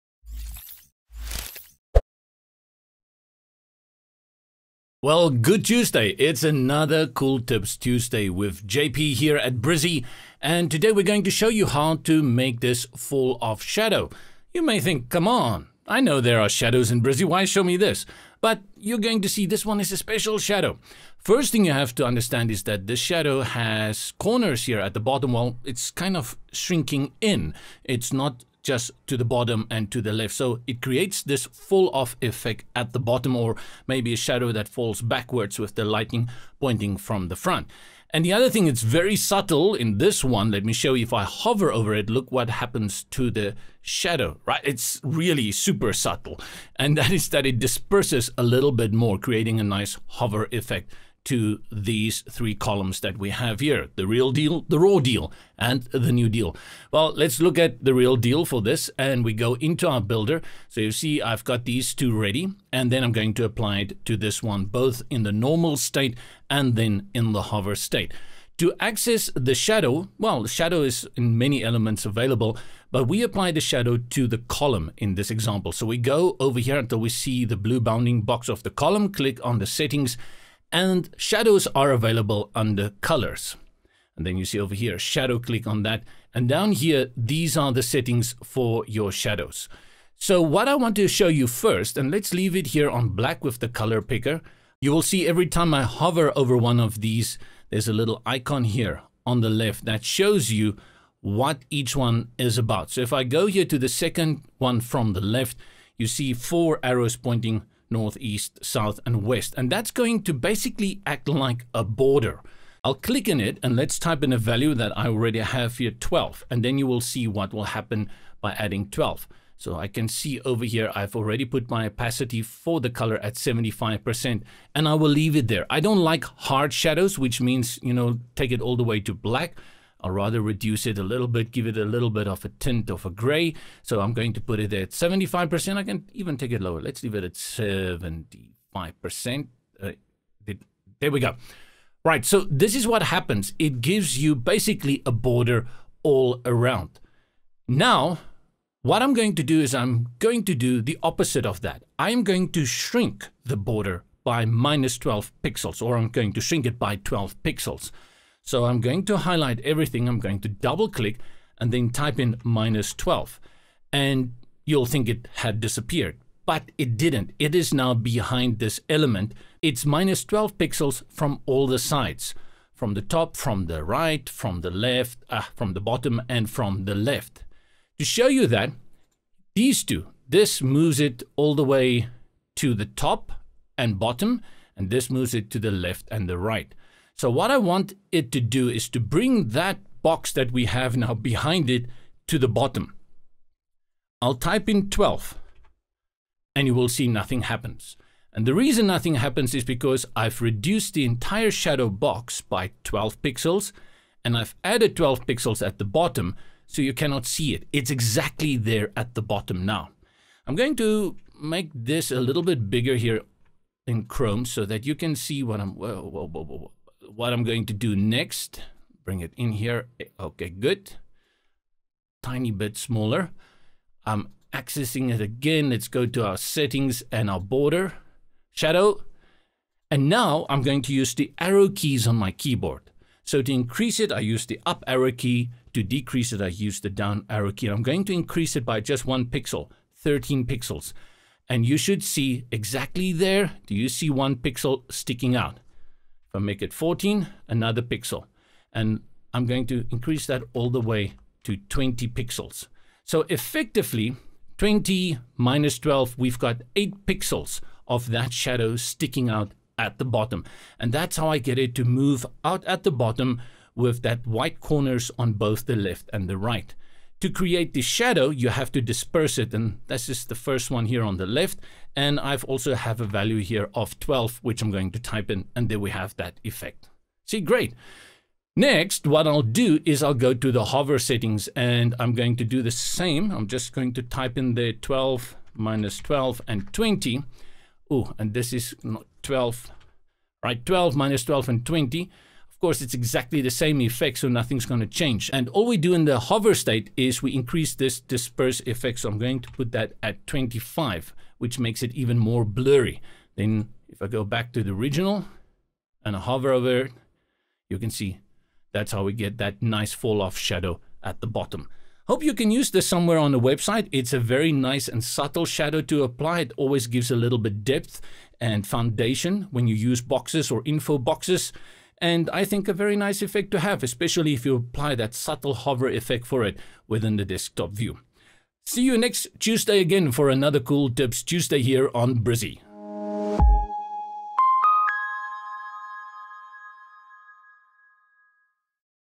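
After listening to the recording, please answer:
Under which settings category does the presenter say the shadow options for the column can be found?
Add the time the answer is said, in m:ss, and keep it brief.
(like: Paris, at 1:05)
colors, at 1:23.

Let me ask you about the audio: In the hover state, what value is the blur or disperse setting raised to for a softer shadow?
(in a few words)
25.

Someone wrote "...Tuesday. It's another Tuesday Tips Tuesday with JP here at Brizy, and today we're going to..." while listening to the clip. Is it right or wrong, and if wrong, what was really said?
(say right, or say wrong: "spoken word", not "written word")
wrong: "Cool", not "Tuesday".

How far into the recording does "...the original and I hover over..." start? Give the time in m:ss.
5:04.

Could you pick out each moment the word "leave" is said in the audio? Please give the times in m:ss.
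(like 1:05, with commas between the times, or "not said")
1:32, 2:05, 2:17.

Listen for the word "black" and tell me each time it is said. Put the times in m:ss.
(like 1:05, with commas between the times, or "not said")
1:33, 2:09.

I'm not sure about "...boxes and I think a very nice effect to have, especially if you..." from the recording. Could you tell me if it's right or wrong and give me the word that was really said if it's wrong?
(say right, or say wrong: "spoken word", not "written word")
right.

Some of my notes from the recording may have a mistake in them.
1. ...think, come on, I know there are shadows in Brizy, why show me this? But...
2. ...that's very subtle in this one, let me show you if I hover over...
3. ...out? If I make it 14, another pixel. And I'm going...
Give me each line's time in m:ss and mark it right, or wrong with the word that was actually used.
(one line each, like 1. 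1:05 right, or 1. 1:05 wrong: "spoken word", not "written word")
1. 0:14 right
2. 0:38 right
3. 4:05 right.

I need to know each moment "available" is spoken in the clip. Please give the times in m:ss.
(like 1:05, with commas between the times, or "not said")
1:12, 1:21.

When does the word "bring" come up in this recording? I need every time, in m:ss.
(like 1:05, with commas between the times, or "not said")
3:08, 3:39.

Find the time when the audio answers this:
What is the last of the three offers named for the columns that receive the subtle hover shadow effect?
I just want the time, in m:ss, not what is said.
0:55.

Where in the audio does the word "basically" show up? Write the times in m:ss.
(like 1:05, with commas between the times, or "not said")
1:50, 2:24.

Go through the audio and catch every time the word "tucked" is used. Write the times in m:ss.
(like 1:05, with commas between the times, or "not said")
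not said.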